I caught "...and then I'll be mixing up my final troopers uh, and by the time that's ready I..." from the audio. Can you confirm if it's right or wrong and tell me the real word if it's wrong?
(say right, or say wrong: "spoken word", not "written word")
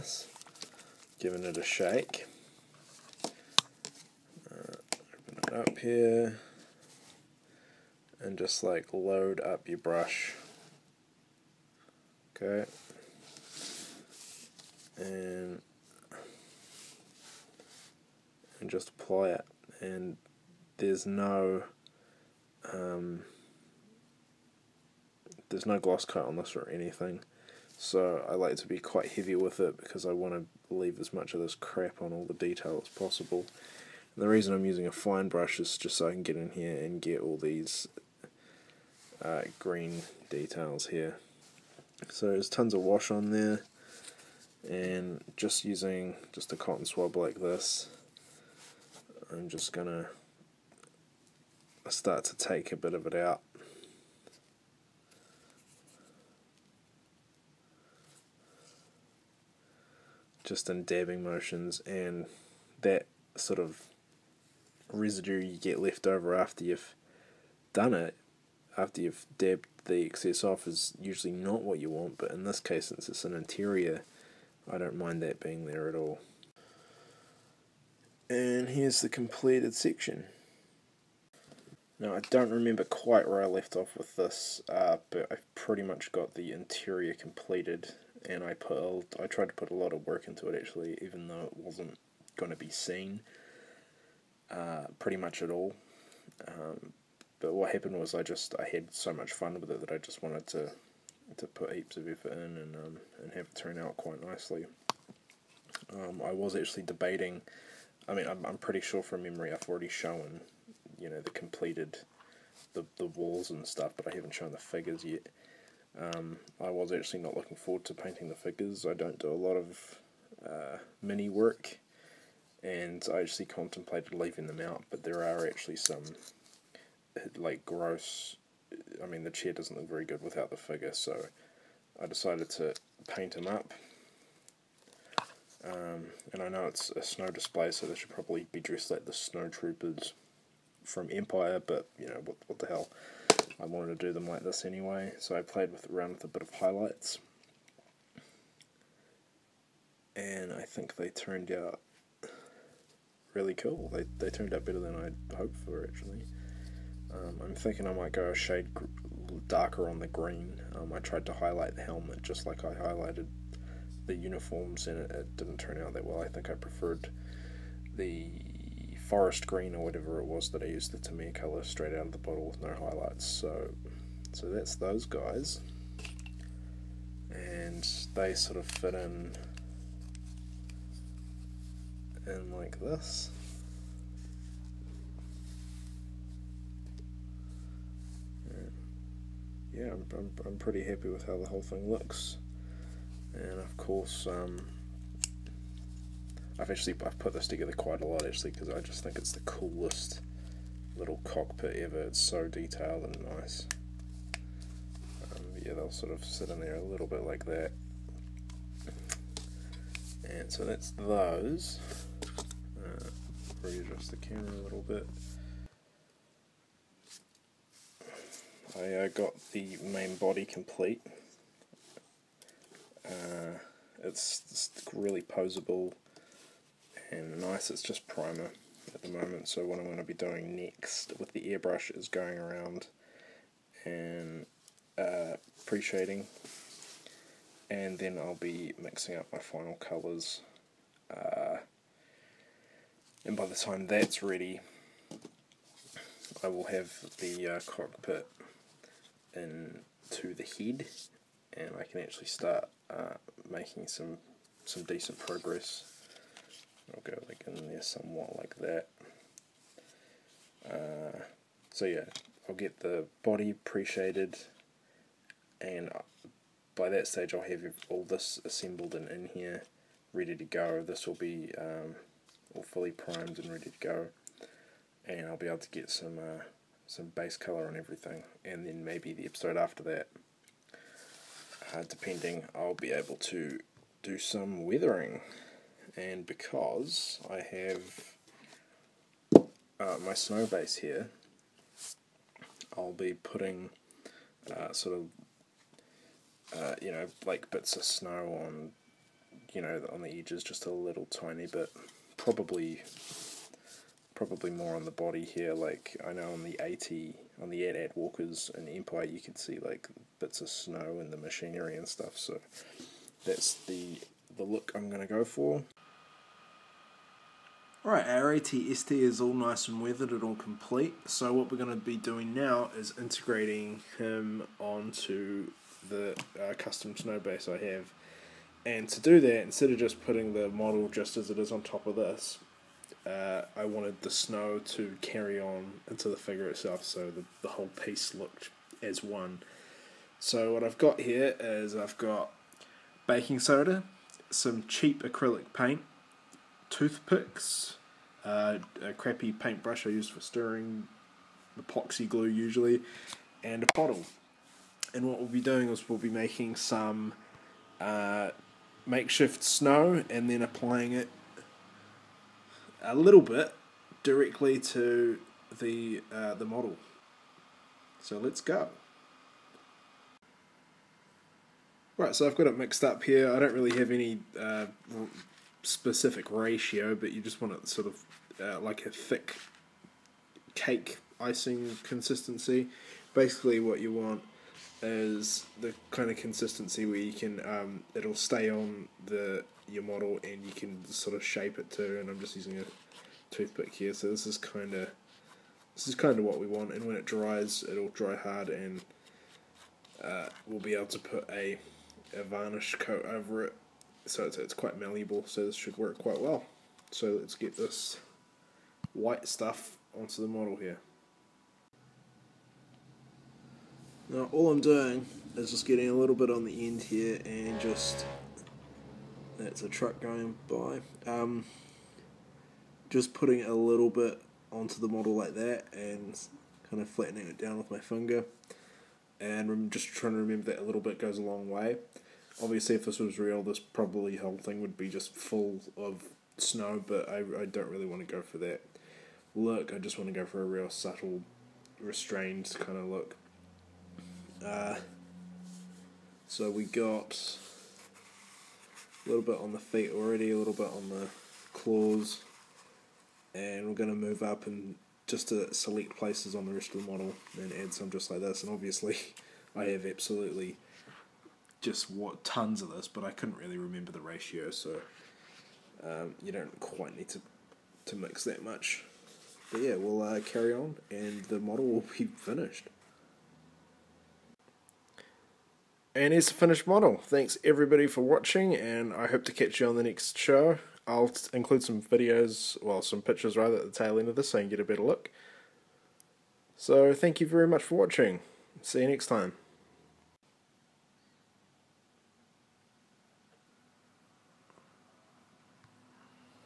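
wrong: "colours", not "troopers".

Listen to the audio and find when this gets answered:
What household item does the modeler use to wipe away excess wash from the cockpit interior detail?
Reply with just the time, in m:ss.
0:46.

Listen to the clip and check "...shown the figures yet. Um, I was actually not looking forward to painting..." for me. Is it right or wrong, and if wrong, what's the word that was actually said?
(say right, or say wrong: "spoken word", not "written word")
right.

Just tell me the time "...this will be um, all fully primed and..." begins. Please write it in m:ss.
4:30.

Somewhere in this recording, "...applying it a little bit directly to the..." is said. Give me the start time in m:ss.
6:00.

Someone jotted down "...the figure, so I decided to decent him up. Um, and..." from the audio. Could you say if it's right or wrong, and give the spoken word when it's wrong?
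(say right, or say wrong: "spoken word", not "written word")
wrong: "paint", not "decent".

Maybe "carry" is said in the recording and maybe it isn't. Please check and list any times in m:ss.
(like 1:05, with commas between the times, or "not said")
5:35, 7:50.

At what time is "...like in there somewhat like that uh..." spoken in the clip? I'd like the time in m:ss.
4:17.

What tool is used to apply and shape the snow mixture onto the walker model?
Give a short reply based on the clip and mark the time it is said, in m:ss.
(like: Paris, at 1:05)
toothpick, at 6:33.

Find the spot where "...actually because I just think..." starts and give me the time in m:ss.
3:18.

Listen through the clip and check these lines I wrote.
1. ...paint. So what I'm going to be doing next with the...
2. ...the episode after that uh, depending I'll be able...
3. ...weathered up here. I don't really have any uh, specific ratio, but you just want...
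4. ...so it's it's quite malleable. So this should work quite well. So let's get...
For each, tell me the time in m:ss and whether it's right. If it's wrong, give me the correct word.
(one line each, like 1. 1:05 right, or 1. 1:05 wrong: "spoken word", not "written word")
1. 3:49 wrong: "moment", not "paint"
2. 4:39 right
3. 6:12 wrong: "mixed", not "weathered"
4. 6:44 right.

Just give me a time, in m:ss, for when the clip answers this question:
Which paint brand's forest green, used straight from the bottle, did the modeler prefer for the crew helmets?
2:50.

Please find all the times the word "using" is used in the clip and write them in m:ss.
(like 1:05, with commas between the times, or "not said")
0:34, 0:45, 6:32.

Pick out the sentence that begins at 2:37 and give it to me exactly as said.
Um, I'm thinking I might go a shade gr- darker on the green.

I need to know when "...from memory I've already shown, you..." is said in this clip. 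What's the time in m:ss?
1:49.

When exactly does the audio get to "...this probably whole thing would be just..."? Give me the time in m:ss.
7:13.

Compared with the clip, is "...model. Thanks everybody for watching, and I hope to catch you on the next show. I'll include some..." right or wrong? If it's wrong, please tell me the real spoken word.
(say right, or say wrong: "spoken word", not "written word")
right.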